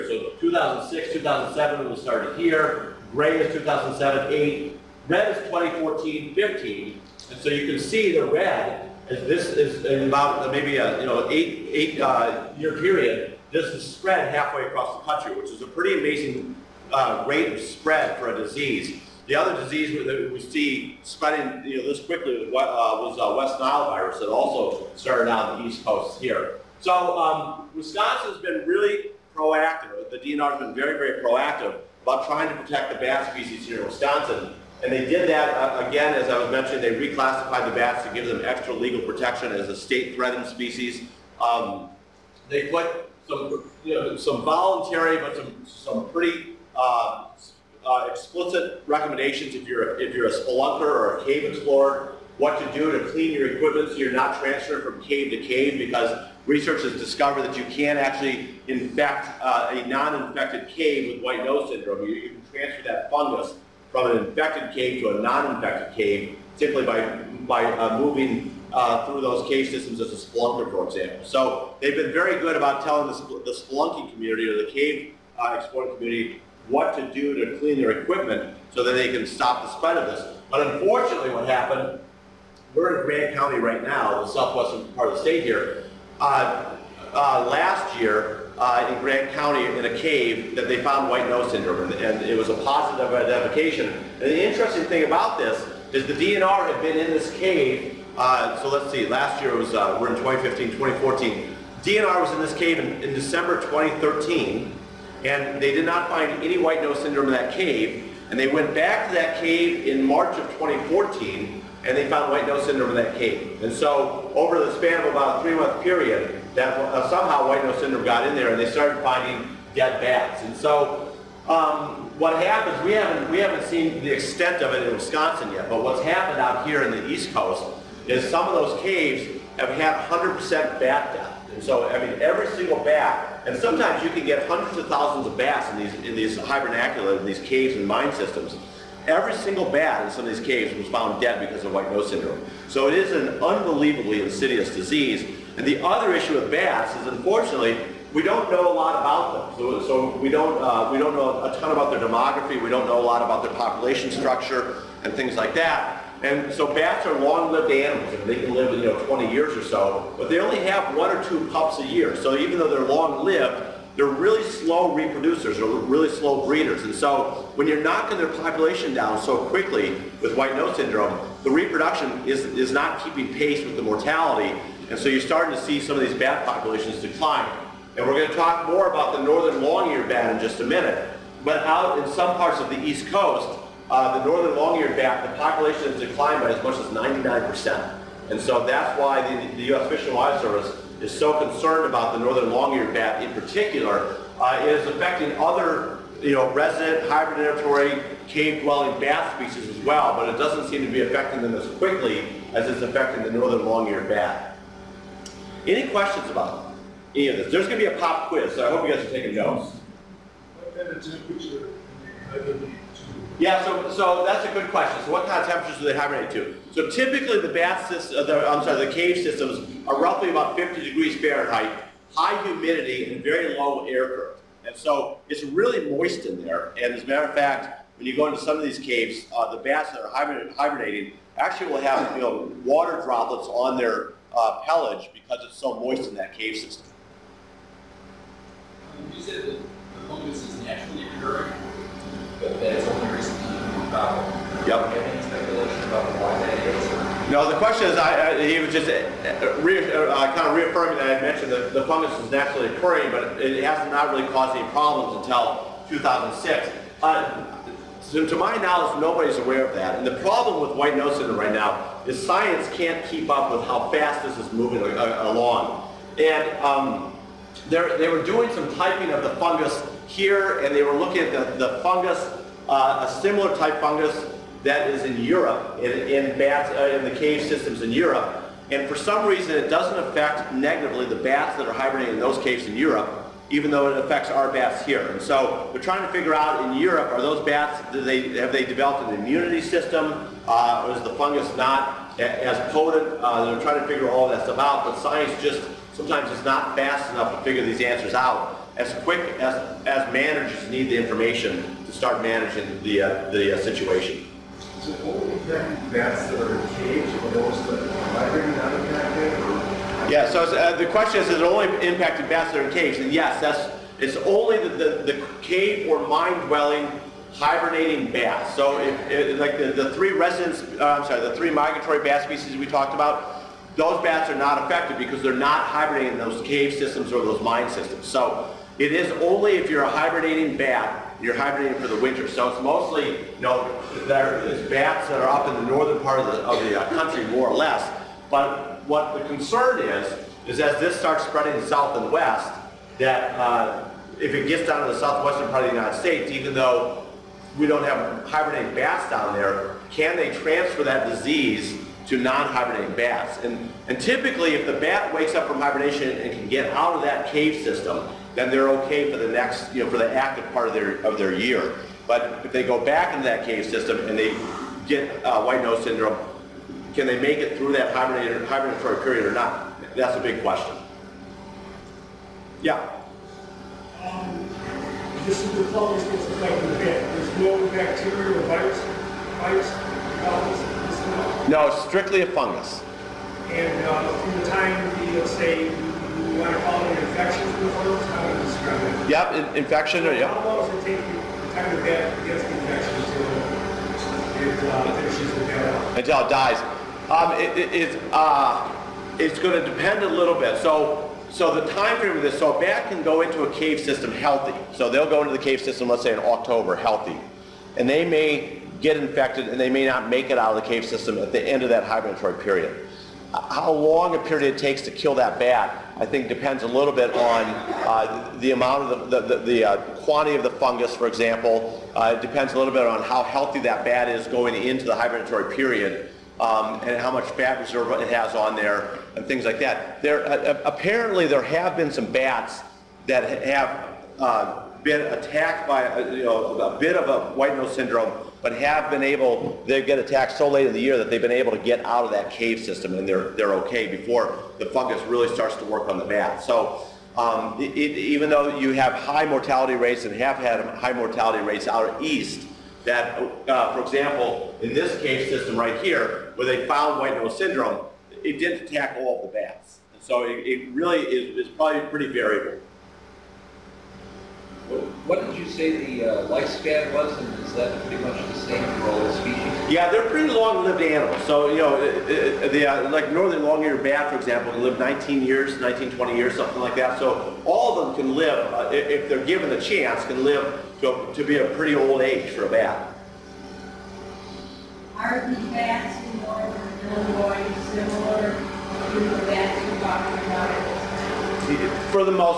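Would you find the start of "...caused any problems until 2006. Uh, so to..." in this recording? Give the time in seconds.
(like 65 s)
254 s.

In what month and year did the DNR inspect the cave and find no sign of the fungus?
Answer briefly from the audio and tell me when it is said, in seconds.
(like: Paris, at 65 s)
December 2013, at 103 s.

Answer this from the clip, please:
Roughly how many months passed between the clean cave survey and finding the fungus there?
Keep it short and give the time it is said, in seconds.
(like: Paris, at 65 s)
3 months, at 115 s.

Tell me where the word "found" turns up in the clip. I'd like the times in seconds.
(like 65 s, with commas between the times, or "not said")
90 s, 112 s, 140 s, 456 s.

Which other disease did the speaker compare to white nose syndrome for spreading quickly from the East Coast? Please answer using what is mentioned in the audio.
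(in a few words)
West Nile virus.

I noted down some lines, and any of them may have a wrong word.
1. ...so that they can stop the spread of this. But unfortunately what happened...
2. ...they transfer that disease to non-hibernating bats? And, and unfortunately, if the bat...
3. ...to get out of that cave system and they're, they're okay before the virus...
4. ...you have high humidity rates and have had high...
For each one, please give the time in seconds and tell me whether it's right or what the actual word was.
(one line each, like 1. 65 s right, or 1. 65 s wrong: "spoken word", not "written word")
1. 78 s right
2. 350 s wrong: "typically", not "unfortunately"
3. 441 s wrong: "fungus", not "virus"
4. 448 s wrong: "mortality", not "humidity".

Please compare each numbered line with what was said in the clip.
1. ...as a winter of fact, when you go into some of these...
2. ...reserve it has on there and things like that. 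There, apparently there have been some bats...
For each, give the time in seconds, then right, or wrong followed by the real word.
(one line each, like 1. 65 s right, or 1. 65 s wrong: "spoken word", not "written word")
1. 226 s wrong: "matter", not "winter"
2. 427 s right.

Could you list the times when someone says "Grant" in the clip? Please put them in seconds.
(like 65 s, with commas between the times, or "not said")
83 s, 89 s.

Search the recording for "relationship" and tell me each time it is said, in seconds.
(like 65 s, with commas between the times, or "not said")
not said.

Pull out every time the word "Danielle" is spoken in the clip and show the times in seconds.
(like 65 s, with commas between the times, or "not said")
not said.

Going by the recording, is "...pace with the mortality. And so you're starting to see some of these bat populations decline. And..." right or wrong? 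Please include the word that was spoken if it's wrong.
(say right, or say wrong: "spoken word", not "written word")
right.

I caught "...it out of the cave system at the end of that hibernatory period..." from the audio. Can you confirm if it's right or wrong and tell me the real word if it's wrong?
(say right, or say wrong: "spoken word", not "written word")
right.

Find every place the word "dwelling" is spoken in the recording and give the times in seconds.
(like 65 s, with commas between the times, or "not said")
198 s, 316 s.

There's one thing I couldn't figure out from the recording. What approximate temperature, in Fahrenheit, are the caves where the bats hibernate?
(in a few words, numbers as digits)
50 degrees.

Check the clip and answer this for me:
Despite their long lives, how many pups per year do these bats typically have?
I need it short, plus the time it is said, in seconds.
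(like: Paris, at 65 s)
1 or 2, at 160 s.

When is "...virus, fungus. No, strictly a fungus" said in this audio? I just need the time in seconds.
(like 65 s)
379 s.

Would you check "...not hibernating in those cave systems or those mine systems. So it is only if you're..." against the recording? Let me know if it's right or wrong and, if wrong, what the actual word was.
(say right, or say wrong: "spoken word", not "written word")
right.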